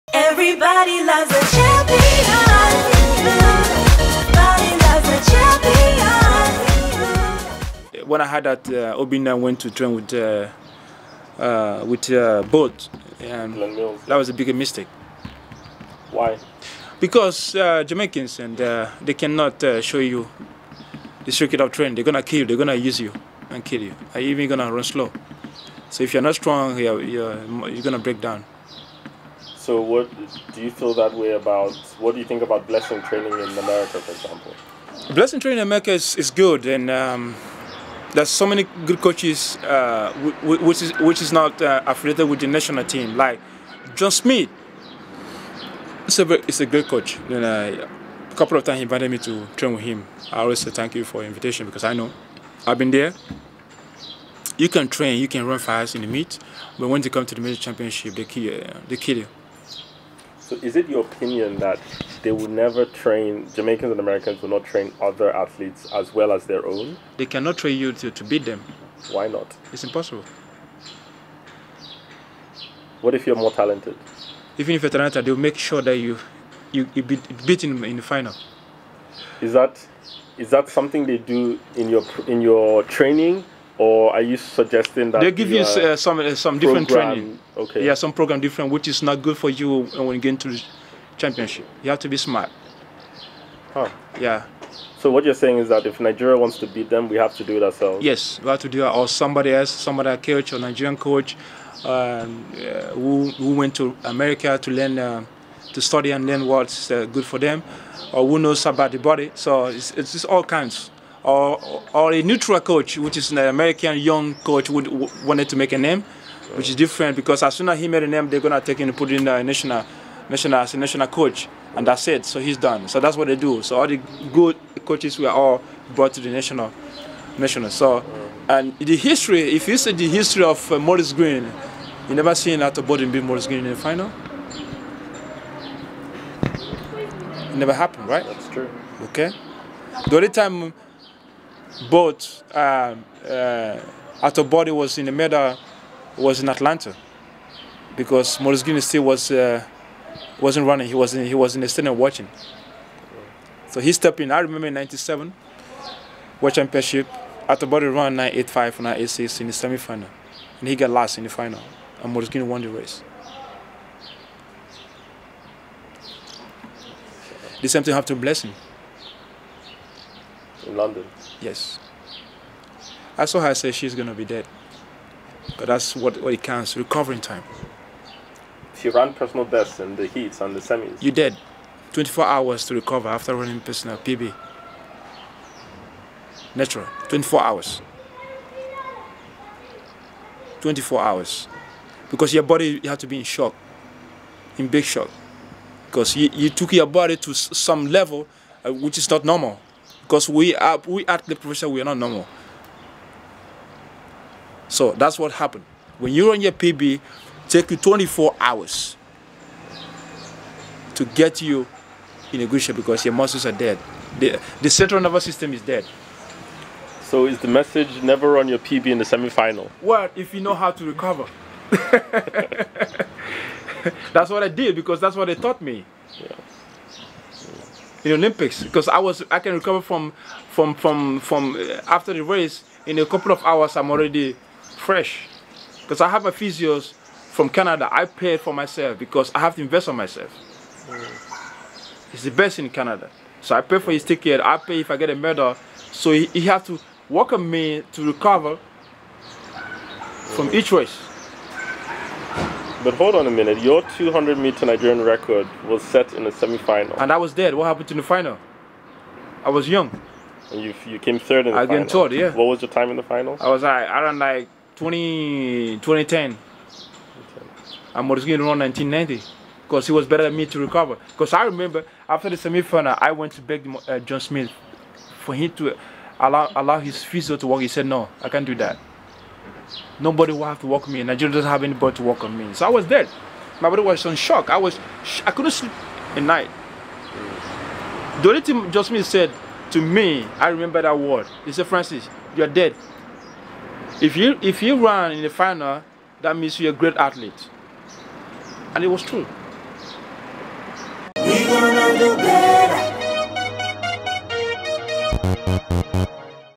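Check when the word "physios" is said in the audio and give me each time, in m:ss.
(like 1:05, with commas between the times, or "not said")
3:56, 4:37.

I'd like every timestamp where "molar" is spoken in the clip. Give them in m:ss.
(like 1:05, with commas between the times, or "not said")
not said.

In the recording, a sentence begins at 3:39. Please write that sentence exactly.
Well, if you know how to recover.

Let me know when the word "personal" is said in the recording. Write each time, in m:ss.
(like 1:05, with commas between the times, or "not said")
2:59, 3:03.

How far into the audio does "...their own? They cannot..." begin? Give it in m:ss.
1:06.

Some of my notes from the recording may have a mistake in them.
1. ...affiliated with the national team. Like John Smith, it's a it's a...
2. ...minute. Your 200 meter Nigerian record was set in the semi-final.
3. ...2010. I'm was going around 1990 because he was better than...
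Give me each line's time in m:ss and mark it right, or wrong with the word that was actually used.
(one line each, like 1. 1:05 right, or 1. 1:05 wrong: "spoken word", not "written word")
1. 0:41 right
2. 4:13 right
3. 4:25 right.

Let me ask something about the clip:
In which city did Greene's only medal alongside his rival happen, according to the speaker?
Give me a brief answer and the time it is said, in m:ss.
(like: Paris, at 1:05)
Atlanta, at 2:26.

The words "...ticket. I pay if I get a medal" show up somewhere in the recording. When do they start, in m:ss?
4:04.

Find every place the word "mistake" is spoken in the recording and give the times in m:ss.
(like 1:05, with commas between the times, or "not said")
0:14.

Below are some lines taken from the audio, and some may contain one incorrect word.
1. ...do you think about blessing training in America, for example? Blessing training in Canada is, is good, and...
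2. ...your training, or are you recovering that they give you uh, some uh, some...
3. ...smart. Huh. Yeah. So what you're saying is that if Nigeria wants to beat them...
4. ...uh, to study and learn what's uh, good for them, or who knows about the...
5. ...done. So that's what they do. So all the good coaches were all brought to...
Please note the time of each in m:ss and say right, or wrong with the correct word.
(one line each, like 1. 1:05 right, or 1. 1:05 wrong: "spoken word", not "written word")
1. 0:32 wrong: "America", not "Canada"
2. 1:22 wrong: "suggesting", not "recovering"
3. 1:32 right
4. 1:44 right
5. 2:02 right.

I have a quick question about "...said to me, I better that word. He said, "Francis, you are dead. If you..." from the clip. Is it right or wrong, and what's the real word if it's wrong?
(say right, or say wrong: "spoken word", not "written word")
wrong: "remember", not "better".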